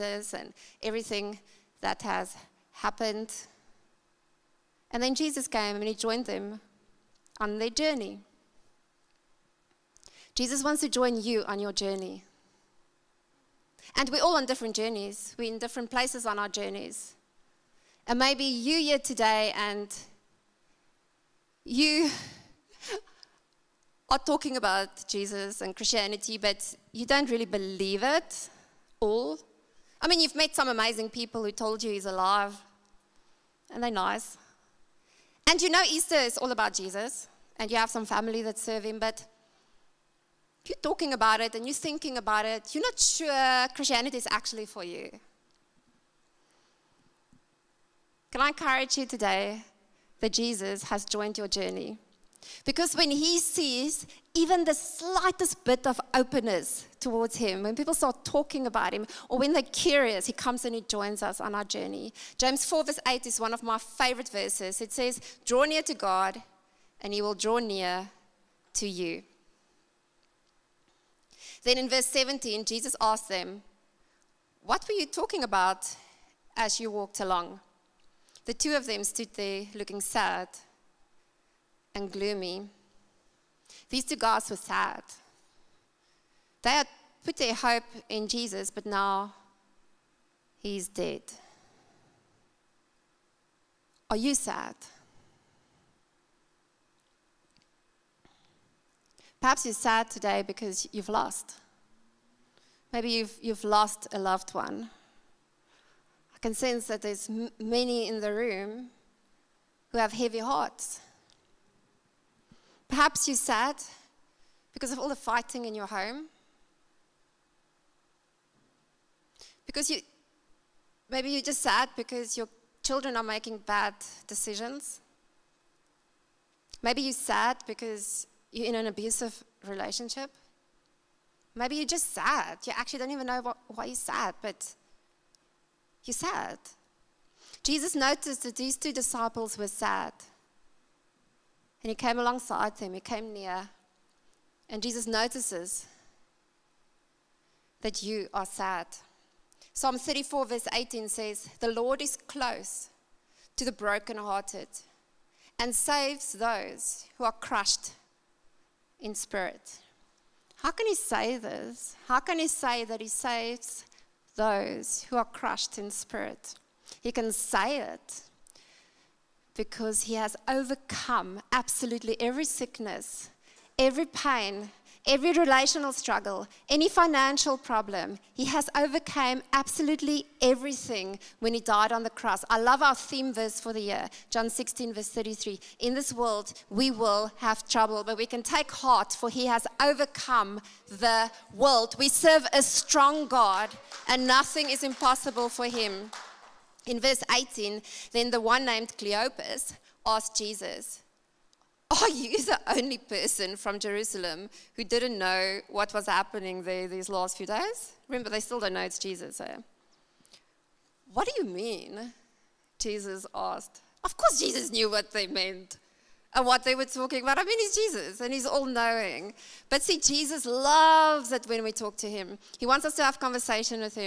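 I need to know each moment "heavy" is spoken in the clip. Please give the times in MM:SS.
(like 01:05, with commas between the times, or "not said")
01:50.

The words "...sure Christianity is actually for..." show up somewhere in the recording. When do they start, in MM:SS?
00:42.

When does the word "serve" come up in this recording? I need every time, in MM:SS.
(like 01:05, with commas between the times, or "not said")
00:38, 03:12.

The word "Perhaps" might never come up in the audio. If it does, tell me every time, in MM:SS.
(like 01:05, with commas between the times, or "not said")
01:39, 01:52.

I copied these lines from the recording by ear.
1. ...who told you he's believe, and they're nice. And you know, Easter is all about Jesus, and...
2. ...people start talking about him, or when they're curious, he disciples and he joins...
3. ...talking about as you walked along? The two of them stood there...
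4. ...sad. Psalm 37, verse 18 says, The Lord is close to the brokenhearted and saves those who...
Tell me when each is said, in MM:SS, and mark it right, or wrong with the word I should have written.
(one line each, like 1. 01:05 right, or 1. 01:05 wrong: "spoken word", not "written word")
1. 00:31 wrong: "alive", not "believe"
2. 00:57 wrong: "comes", not "disciples"
3. 01:15 right
4. 02:28 wrong: "34", not "37".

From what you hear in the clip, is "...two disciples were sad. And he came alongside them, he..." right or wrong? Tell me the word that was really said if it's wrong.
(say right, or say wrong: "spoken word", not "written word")
right.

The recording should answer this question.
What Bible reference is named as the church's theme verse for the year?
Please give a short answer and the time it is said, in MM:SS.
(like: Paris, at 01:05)
John 16:33, at 03:04.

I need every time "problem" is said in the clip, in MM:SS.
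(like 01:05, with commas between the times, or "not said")
02:57.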